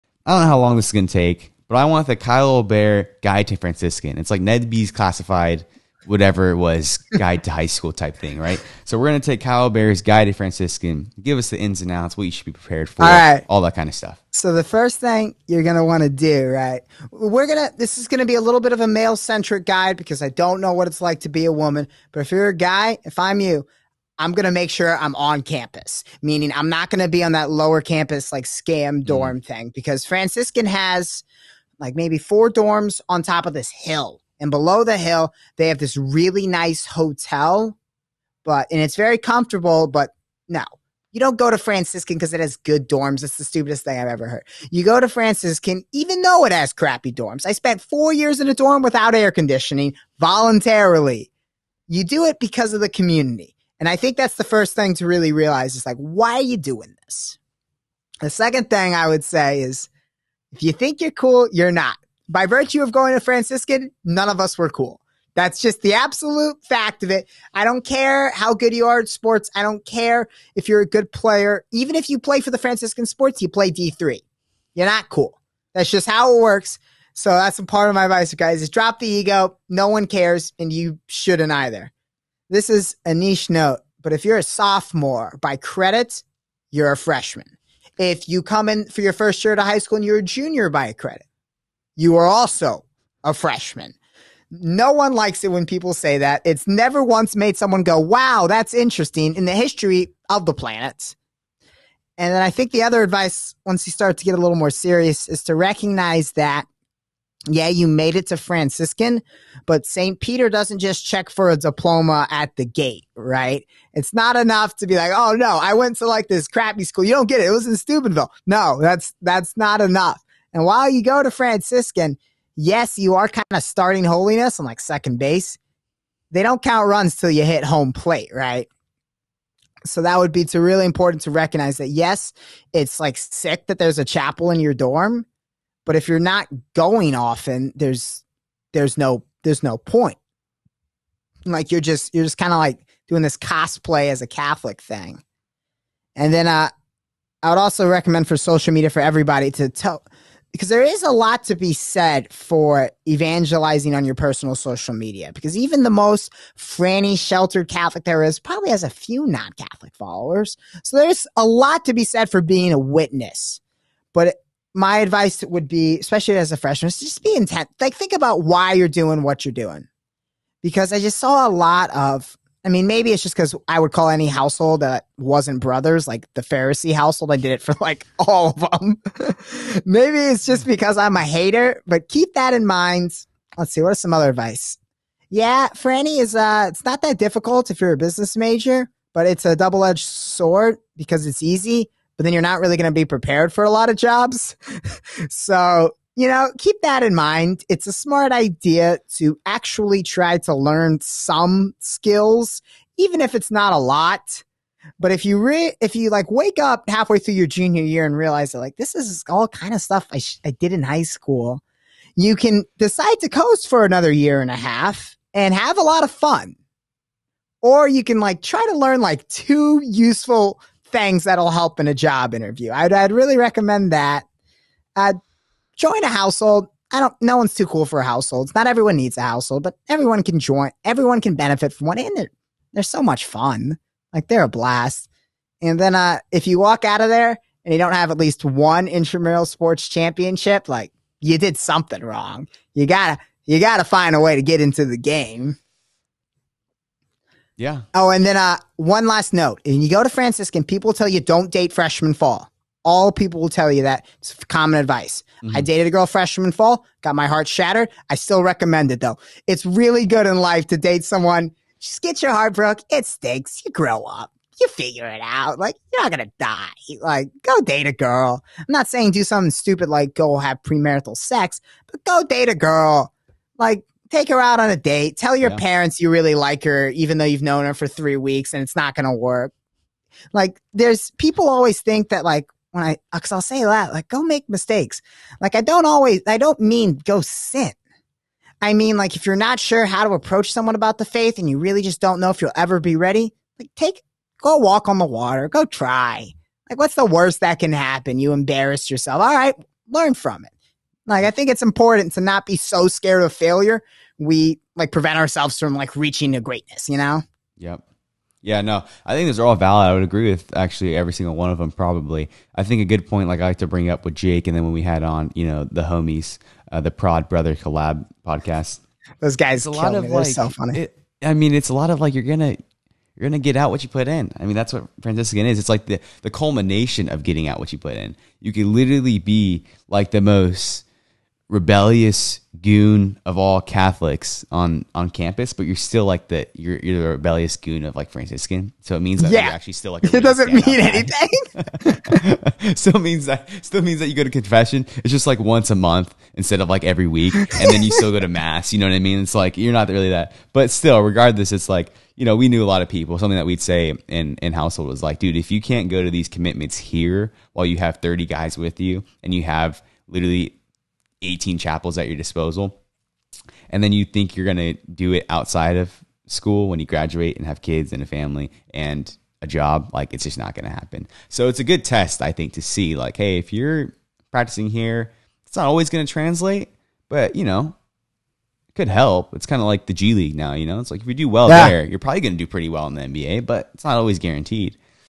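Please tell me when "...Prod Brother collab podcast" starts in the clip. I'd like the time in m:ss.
5:16.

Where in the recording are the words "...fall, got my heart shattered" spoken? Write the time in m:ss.
4:16.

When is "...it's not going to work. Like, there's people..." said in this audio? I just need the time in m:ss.
4:38.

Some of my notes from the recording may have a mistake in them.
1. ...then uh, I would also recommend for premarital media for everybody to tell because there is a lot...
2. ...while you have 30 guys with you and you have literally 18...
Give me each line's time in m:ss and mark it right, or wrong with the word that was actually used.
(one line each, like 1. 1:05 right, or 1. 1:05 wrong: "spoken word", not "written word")
1. 2:26 wrong: "social", not "premarital"
2. 5:57 right.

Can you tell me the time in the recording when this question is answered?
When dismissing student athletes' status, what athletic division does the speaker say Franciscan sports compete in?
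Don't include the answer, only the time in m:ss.
1:13.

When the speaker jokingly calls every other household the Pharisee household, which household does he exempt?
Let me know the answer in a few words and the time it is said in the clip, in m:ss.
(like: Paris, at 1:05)
Brothers, at 2:55.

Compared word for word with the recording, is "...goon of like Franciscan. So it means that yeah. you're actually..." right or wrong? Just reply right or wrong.
right.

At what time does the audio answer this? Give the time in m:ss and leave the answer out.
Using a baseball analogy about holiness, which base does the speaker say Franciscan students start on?
2:04.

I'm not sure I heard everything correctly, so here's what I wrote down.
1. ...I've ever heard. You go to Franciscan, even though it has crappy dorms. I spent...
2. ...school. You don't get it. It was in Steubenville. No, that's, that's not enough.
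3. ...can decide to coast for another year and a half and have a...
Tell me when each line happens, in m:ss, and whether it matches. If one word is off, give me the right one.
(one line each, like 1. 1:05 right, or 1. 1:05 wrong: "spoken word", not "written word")
1. 0:43 right
2. 1:56 right
3. 3:32 right.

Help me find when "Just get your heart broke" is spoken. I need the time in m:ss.
4:21.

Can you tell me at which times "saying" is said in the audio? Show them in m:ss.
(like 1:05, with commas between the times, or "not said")
4:28.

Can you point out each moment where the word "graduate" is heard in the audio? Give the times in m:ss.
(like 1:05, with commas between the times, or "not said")
6:06.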